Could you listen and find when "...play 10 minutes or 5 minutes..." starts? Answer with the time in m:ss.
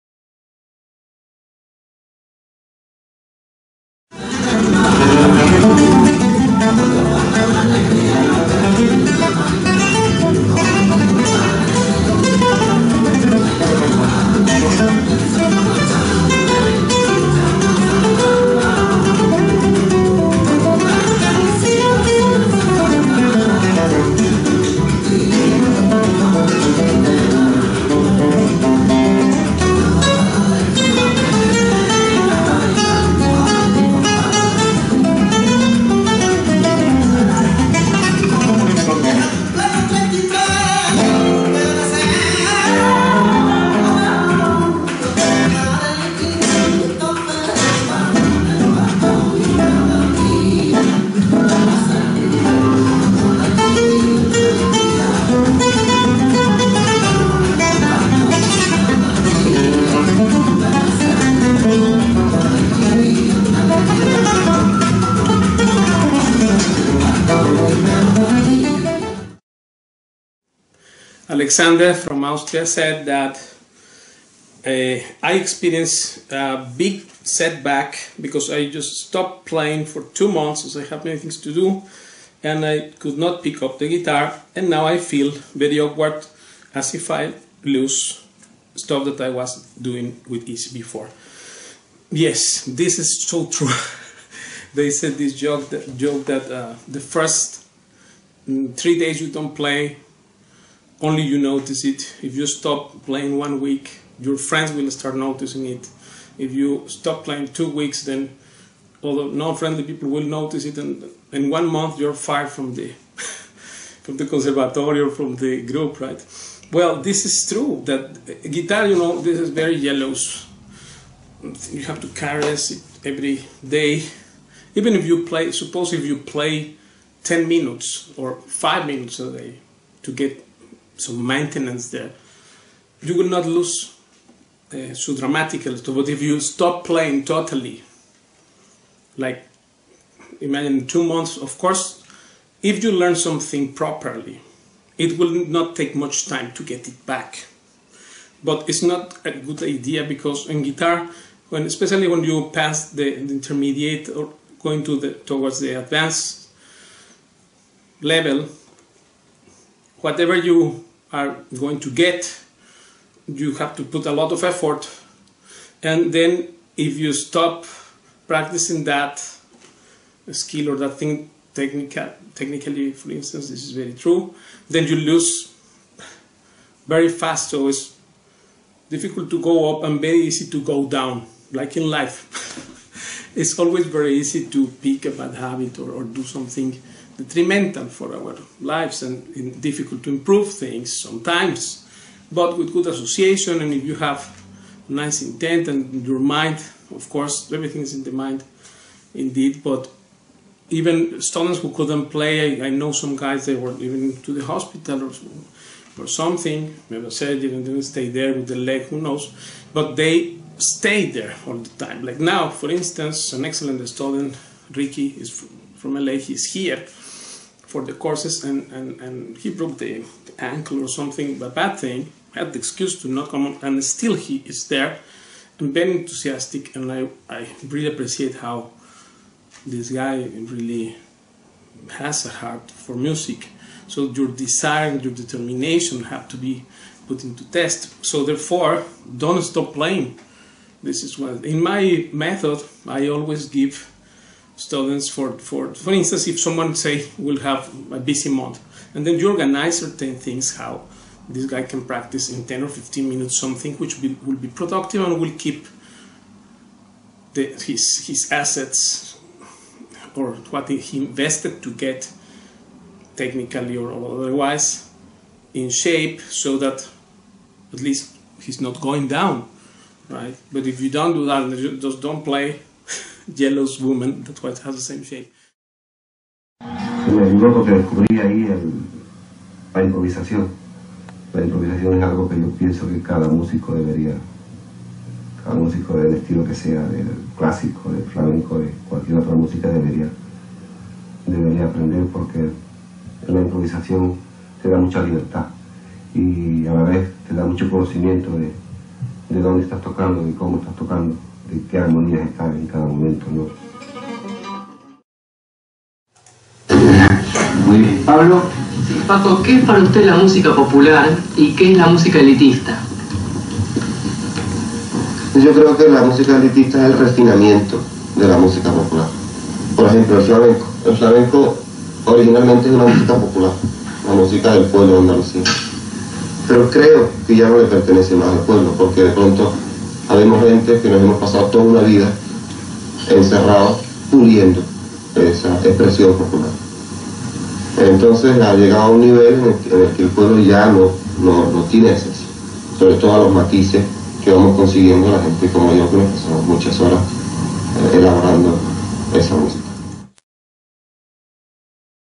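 2:06.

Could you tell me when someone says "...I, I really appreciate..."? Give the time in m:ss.
3:46.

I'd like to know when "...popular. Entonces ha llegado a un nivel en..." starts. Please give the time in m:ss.
5:36.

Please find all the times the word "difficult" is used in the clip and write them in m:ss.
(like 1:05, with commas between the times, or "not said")
2:58, 3:09.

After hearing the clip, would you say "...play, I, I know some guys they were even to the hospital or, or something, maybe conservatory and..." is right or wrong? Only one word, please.
wrong.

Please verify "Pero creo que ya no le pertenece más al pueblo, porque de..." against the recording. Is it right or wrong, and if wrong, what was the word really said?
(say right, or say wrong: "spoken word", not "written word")
right.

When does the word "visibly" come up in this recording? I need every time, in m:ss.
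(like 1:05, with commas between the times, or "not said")
not said.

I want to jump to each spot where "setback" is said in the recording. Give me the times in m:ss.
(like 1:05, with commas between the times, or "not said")
1:17.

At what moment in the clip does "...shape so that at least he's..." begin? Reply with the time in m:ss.
4:25.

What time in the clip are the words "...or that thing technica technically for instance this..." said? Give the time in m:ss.
2:50.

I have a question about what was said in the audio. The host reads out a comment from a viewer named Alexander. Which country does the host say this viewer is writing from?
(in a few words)
Austria.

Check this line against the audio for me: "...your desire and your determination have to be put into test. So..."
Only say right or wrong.
right.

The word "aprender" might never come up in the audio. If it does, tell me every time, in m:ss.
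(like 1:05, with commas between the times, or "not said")
4:51.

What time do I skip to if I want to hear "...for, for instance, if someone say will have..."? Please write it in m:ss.
4:05.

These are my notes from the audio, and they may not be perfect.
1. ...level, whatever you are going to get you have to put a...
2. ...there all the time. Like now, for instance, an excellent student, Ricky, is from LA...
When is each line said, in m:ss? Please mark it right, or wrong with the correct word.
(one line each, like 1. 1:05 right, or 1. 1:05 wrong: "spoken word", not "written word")
1. 2:38 right
2. 3:31 right.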